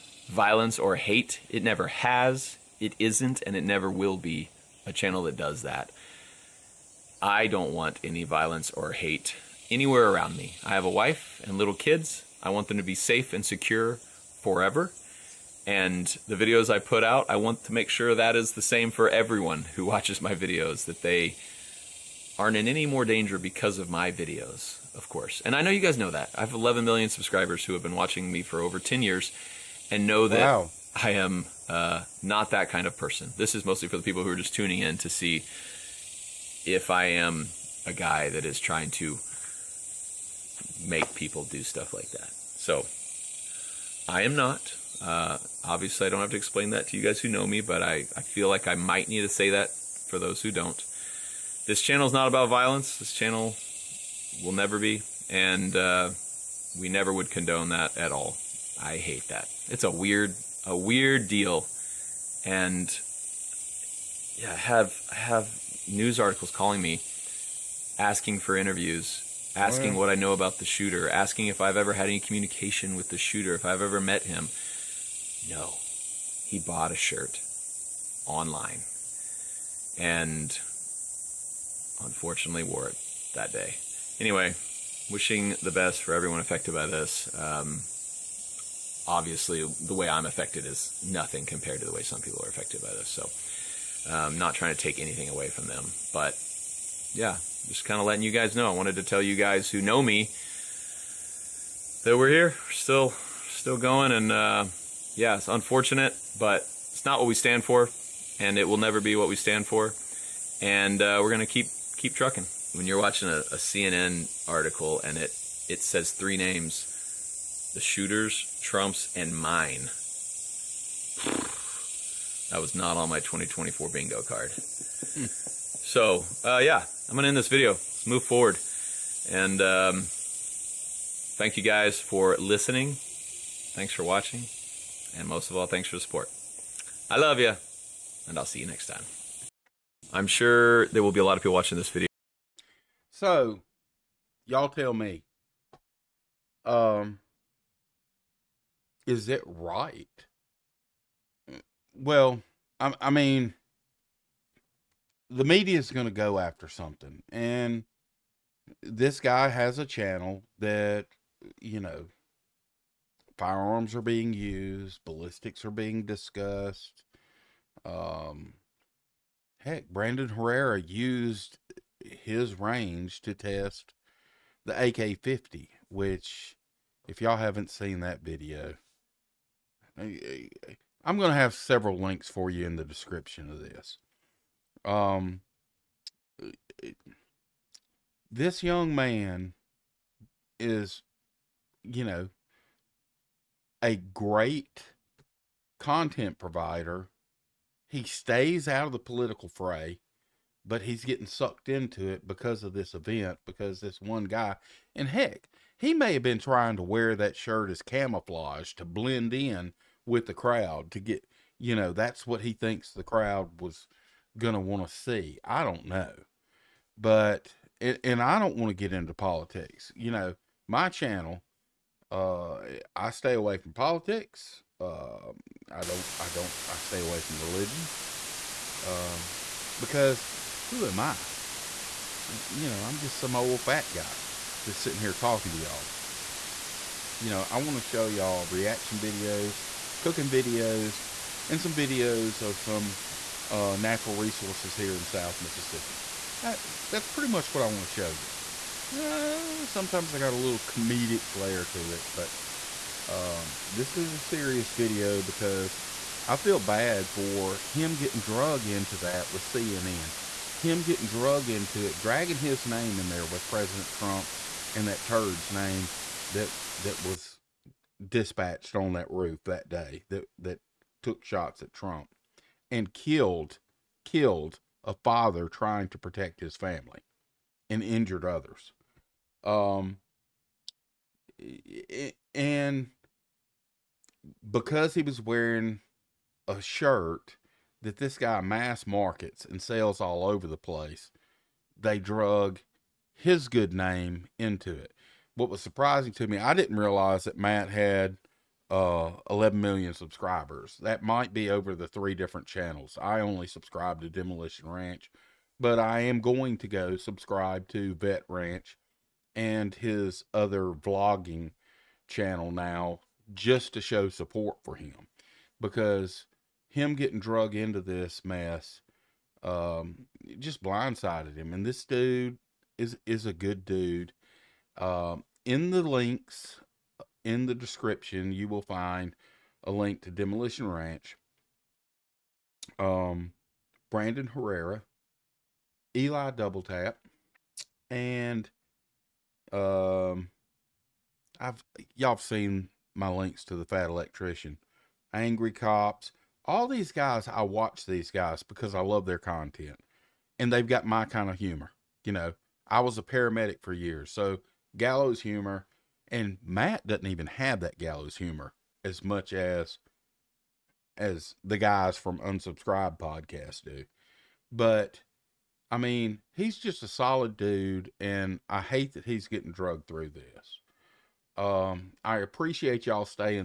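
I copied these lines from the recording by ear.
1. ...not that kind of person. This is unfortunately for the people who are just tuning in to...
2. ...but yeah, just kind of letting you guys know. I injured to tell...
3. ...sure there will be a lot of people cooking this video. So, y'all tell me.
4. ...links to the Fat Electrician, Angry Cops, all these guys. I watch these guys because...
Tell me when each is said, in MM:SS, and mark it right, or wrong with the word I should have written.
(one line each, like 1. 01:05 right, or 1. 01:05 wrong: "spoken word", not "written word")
1. 00:32 wrong: "mostly", not "unfortunately"
2. 01:36 wrong: "wanted", not "injured"
3. 02:20 wrong: "watching", not "cooking"
4. 05:43 right.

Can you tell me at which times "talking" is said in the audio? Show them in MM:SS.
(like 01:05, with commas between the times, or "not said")
03:55.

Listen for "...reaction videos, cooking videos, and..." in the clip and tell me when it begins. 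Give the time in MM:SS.
03:58.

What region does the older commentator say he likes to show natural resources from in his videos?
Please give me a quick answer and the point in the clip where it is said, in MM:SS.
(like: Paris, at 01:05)
South Mississippi, at 04:05.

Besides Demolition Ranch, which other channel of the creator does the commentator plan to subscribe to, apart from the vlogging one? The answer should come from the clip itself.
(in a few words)
Vet Ranch.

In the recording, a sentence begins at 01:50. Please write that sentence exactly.
And uh, we're gonna keep keep trucking.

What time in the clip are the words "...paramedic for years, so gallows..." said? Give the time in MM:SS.
05:53.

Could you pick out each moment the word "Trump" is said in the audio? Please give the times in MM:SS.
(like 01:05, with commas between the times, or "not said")
01:58, 04:23, 04:31.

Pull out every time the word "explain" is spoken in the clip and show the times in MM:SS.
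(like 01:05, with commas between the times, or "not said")
00:46.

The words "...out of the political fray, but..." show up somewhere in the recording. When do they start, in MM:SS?
03:18.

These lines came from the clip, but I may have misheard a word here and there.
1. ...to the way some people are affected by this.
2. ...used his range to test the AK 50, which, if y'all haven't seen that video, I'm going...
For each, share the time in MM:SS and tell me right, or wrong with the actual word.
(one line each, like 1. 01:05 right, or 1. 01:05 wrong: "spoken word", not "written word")
1. 01:31 right
2. 02:50 right.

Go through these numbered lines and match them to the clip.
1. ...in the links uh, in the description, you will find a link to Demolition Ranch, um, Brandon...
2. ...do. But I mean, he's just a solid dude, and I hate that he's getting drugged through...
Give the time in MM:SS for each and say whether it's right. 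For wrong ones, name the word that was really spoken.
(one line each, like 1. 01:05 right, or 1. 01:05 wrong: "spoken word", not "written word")
1. 05:25 right
2. 06:03 right.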